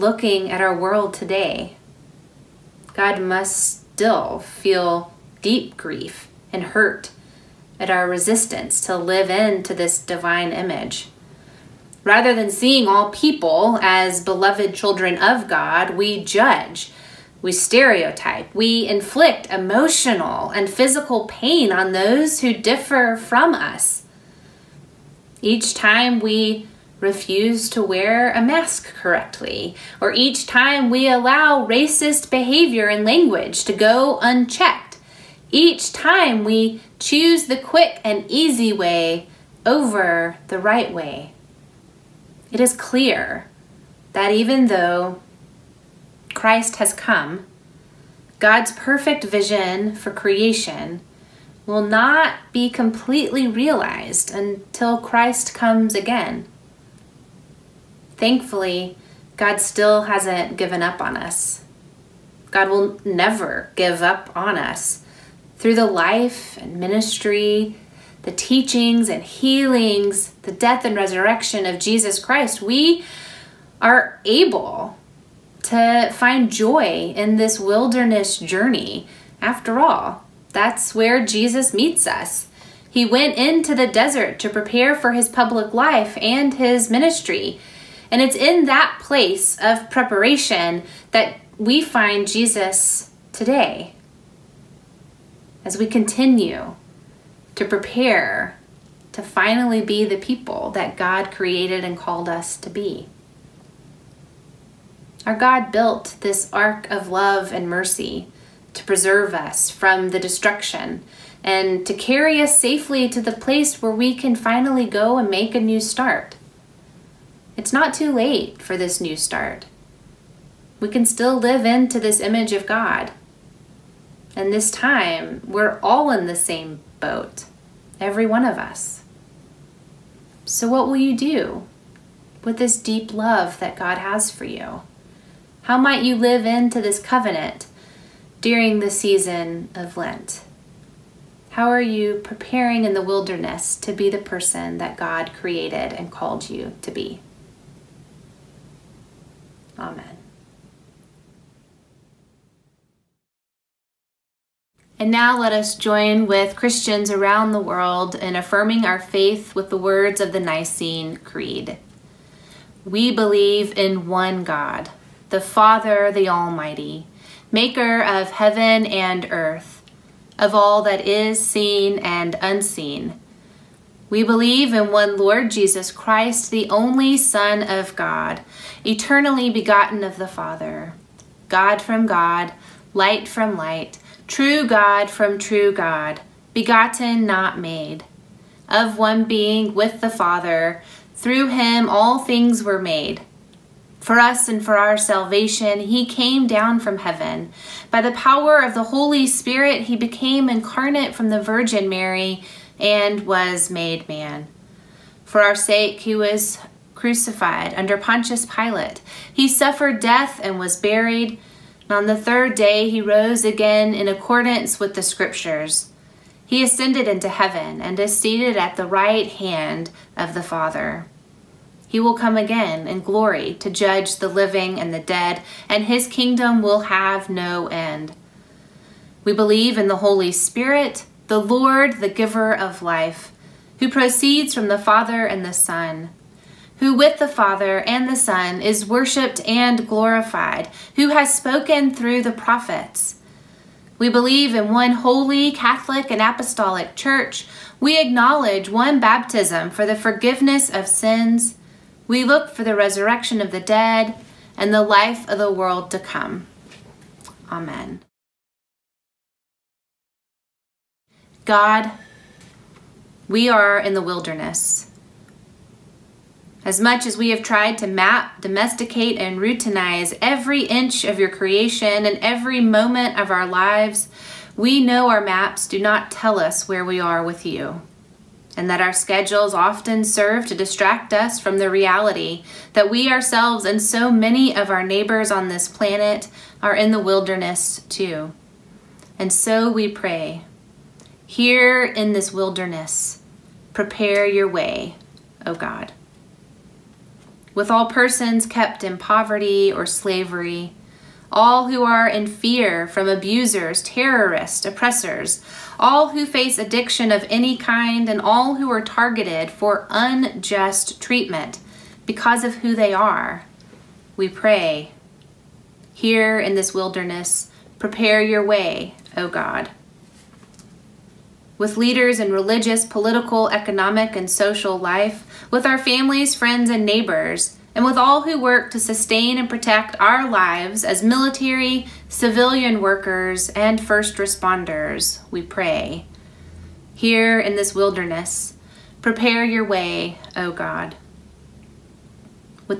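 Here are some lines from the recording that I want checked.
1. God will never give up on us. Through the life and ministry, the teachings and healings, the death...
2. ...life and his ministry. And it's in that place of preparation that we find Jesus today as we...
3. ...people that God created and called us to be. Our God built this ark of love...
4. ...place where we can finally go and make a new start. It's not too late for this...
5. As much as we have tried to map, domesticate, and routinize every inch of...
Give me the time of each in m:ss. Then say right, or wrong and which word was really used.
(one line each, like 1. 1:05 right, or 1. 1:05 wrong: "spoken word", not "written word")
1. 1:02 right
2. 1:25 right
3. 1:40 right
4. 1:53 right
5. 4:26 right.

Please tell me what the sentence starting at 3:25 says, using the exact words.
For our sake, he was crucified under Pontius Pilate.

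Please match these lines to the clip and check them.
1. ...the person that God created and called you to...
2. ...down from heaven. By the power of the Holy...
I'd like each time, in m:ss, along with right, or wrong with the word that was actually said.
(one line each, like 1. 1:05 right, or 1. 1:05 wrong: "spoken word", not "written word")
1. 2:24 right
2. 3:16 right.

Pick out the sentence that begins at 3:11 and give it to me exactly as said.
Through him all things were made.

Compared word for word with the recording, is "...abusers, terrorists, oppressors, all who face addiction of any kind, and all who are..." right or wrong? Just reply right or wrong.
right.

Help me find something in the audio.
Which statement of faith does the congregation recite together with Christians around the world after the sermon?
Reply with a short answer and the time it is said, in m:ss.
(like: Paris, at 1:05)
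Nicene Creed, at 2:40.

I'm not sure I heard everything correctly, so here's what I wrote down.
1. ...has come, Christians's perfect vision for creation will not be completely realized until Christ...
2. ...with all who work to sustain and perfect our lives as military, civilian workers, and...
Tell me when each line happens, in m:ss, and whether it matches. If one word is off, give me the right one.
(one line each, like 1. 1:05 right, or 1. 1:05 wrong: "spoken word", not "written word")
1. 0:46 wrong: "God", not "Christians"
2. 5:27 wrong: "protect", not "perfect".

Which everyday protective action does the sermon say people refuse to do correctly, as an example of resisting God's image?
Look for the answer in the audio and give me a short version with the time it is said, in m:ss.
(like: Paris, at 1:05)
wear a mask, at 0:27.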